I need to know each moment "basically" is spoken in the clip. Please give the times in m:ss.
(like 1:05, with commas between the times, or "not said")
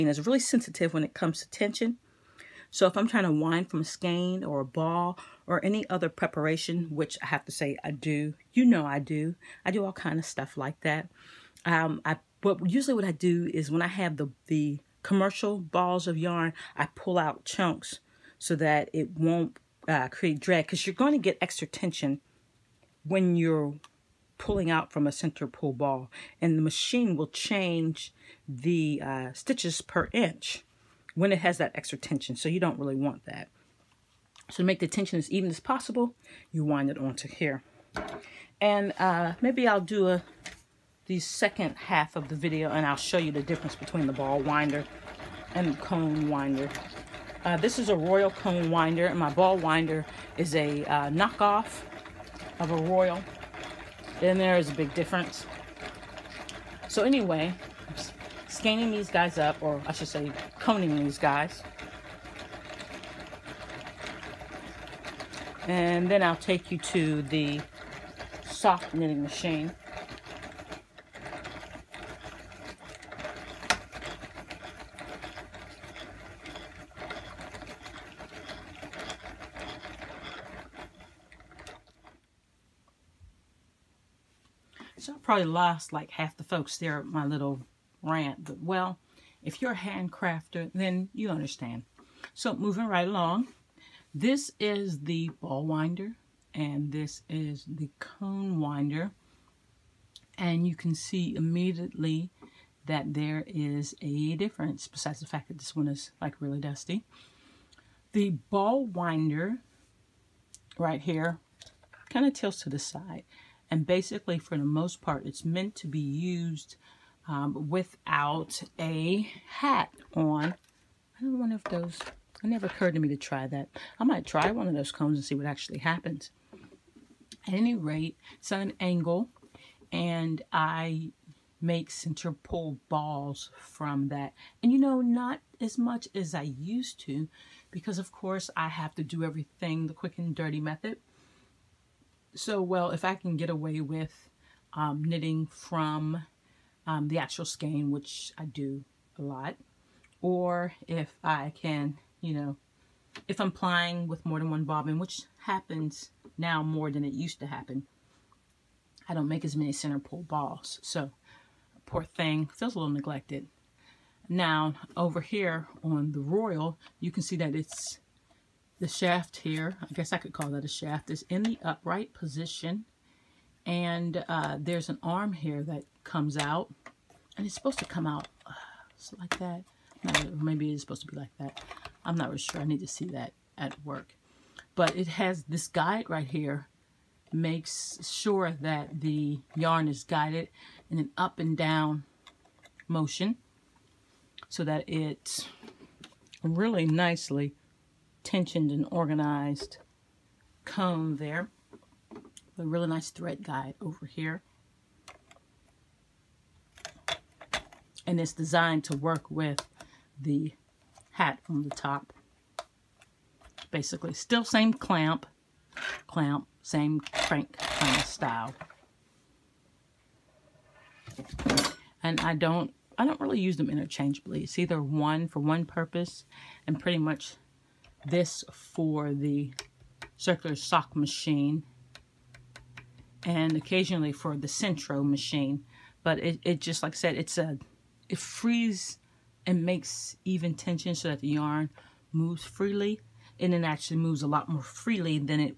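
1:53, 3:33.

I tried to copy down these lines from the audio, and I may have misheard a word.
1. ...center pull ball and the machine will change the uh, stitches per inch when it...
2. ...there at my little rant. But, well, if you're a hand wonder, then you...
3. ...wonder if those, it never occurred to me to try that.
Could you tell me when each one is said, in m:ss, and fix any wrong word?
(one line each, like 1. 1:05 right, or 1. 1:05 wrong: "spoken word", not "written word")
1. 0:25 right
2. 1:26 wrong: "crafter", not "wonder"
3. 2:01 right.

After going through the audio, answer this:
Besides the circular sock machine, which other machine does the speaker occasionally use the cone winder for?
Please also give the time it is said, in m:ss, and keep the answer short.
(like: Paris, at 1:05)
Sentro machine, at 3:54.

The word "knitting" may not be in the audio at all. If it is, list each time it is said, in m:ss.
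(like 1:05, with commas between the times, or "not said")
1:08, 2:25.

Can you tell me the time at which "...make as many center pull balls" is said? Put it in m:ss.
2:39.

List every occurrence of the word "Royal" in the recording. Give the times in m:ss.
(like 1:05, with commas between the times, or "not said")
0:47, 0:52, 2:46.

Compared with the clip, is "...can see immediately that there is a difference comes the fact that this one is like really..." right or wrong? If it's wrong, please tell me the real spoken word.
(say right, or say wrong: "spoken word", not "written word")
wrong: "besides", not "comes".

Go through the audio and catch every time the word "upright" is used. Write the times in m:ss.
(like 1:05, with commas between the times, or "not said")
2:51.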